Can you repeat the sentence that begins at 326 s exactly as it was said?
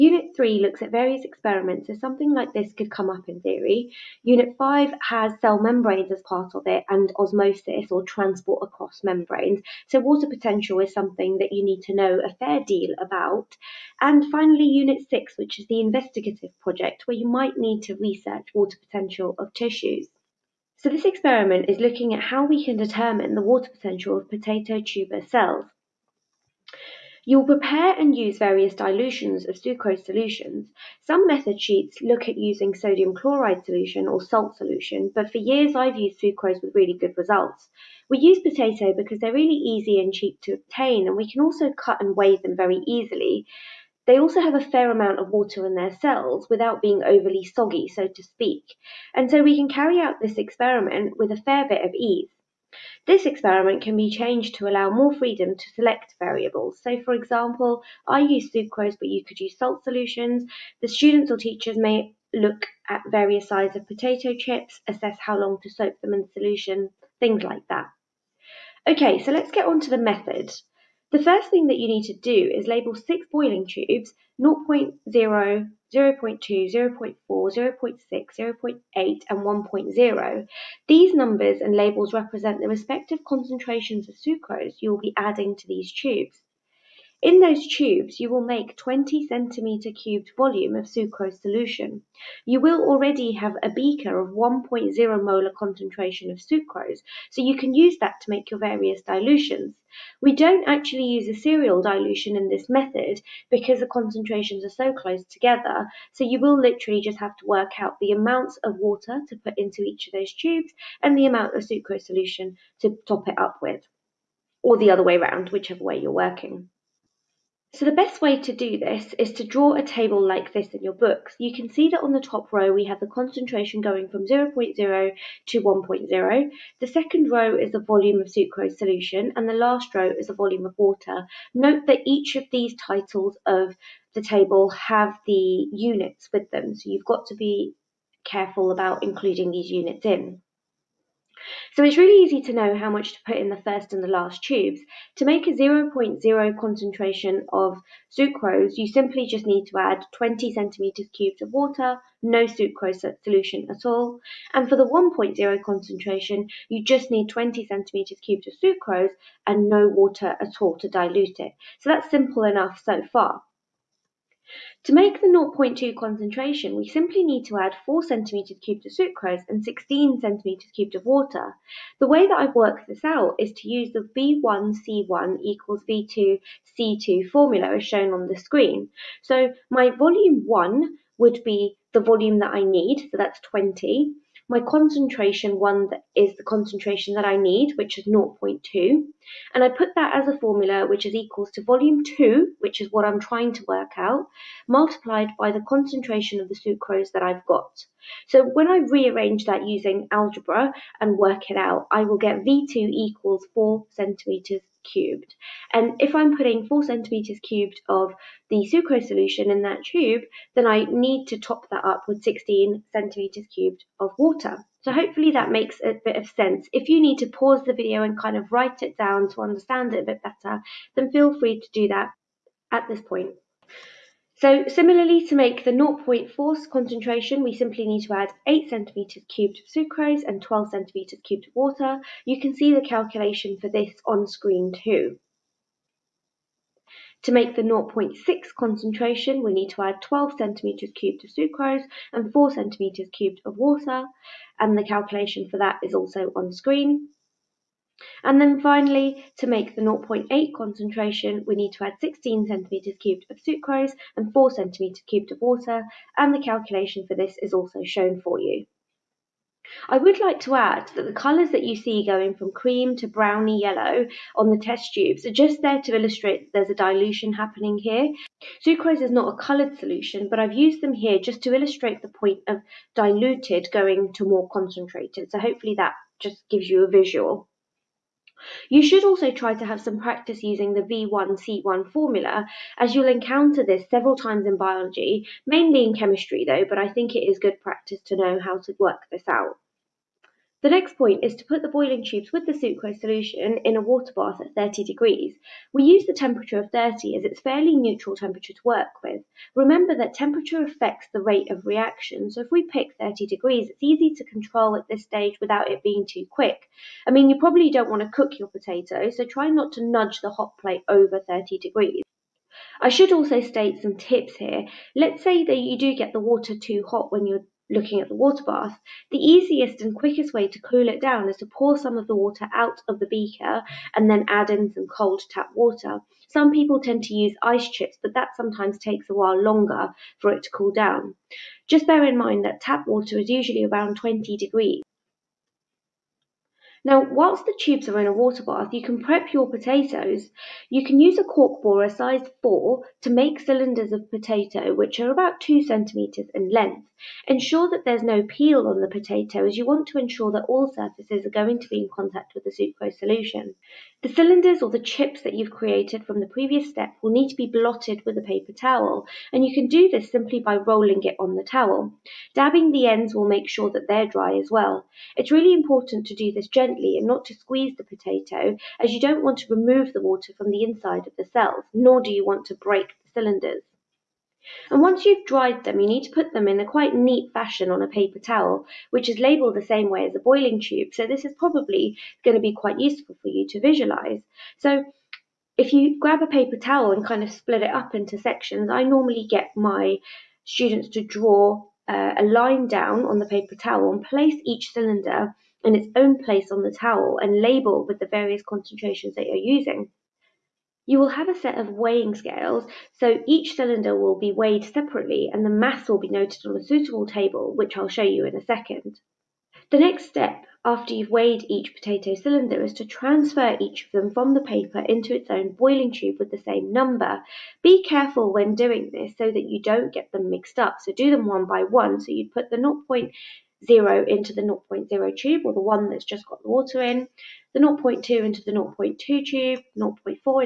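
Some people tend to use ice chips, but that sometimes takes a while longer for it to cool down.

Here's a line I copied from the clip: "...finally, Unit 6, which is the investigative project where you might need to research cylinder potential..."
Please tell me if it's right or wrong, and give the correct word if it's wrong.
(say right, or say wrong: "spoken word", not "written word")
wrong: "water", not "cylinder".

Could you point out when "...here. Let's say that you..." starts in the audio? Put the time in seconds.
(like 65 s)
314 s.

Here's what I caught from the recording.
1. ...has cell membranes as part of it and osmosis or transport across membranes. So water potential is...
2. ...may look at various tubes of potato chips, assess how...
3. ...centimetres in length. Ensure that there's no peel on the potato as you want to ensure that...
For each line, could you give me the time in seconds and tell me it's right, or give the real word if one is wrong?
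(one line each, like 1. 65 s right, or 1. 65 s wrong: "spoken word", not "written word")
1. 5 s right
2. 61 s wrong: "sizes", not "tubes"
3. 345 s right.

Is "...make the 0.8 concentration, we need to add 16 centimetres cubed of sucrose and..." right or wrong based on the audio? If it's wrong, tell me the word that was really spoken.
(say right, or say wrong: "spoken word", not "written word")
right.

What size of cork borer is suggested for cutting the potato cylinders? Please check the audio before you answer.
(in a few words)
size 4.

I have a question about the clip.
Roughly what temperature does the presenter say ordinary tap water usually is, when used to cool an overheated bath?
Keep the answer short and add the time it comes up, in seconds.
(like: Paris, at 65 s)
20 degrees, at 333 s.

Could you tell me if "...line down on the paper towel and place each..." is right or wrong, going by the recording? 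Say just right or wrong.
right.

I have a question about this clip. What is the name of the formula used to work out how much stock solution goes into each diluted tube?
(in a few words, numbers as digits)
V1C1 equals V2C2.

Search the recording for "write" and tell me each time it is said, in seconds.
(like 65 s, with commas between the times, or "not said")
218 s.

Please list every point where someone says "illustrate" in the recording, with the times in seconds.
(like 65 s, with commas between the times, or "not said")
265 s, 271 s.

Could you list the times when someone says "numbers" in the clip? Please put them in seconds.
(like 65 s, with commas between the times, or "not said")
81 s, 416 s.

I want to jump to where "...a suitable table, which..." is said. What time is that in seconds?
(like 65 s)
406 s.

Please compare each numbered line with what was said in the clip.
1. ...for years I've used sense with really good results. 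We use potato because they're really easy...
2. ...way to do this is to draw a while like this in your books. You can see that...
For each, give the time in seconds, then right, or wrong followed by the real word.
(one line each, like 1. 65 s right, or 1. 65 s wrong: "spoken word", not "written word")
1. 35 s wrong: "sucrose", not "sense"
2. 118 s wrong: "table", not "while".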